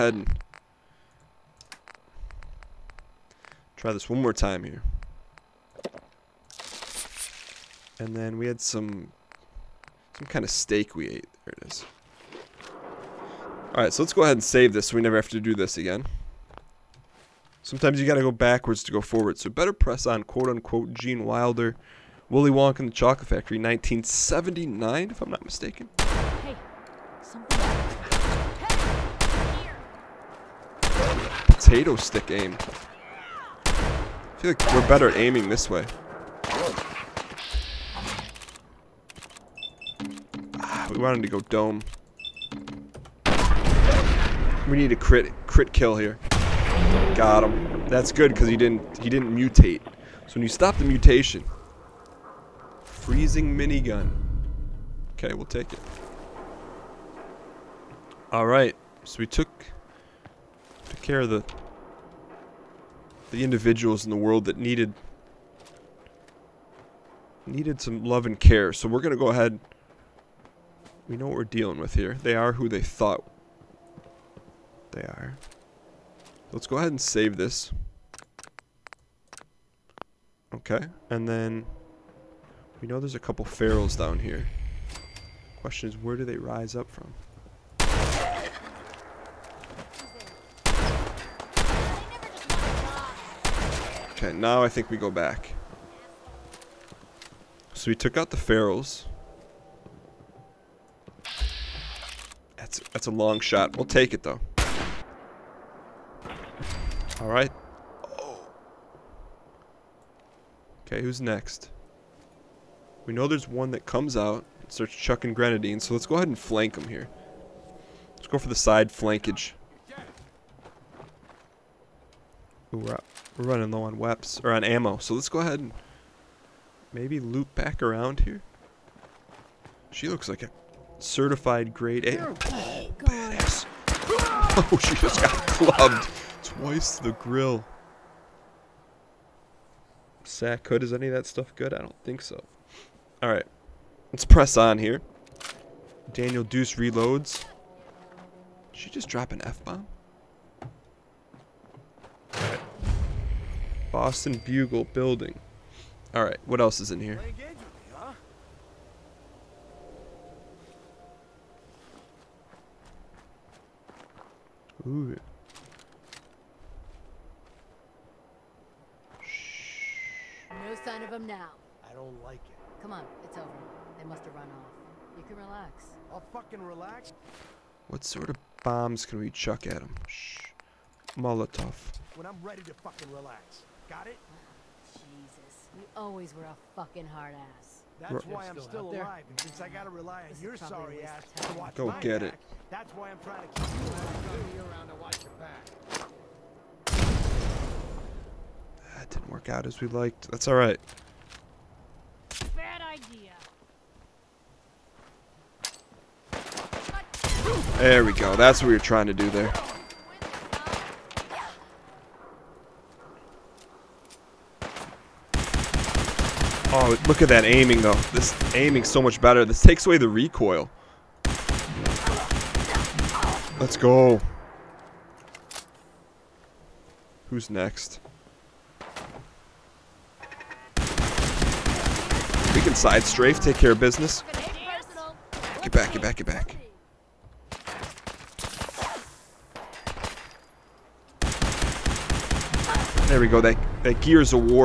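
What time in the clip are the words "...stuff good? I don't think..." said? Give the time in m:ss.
2:21.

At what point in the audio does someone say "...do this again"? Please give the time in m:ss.
0:15.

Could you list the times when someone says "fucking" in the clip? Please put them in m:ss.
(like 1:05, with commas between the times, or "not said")
2:56, 3:02, 3:06.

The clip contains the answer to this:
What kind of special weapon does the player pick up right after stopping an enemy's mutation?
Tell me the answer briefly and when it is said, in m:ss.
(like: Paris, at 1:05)
freezing minigun, at 0:52.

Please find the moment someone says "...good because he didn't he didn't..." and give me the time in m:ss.
0:48.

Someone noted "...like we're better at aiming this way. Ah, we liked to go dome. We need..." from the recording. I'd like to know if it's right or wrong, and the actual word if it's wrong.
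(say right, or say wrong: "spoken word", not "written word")
wrong: "wanted", not "liked".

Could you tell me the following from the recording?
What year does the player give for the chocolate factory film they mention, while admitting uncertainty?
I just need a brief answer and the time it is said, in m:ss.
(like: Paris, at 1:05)
1979, at 0:23.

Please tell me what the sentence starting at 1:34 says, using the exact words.
Okay, now I think we go back.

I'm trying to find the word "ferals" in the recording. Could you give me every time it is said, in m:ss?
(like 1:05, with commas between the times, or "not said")
1:23, 1:38.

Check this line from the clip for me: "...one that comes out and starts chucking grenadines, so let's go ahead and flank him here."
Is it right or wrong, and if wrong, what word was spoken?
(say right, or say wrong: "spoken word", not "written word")
right.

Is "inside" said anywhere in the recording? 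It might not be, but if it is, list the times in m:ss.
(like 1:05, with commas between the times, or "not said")
3:52.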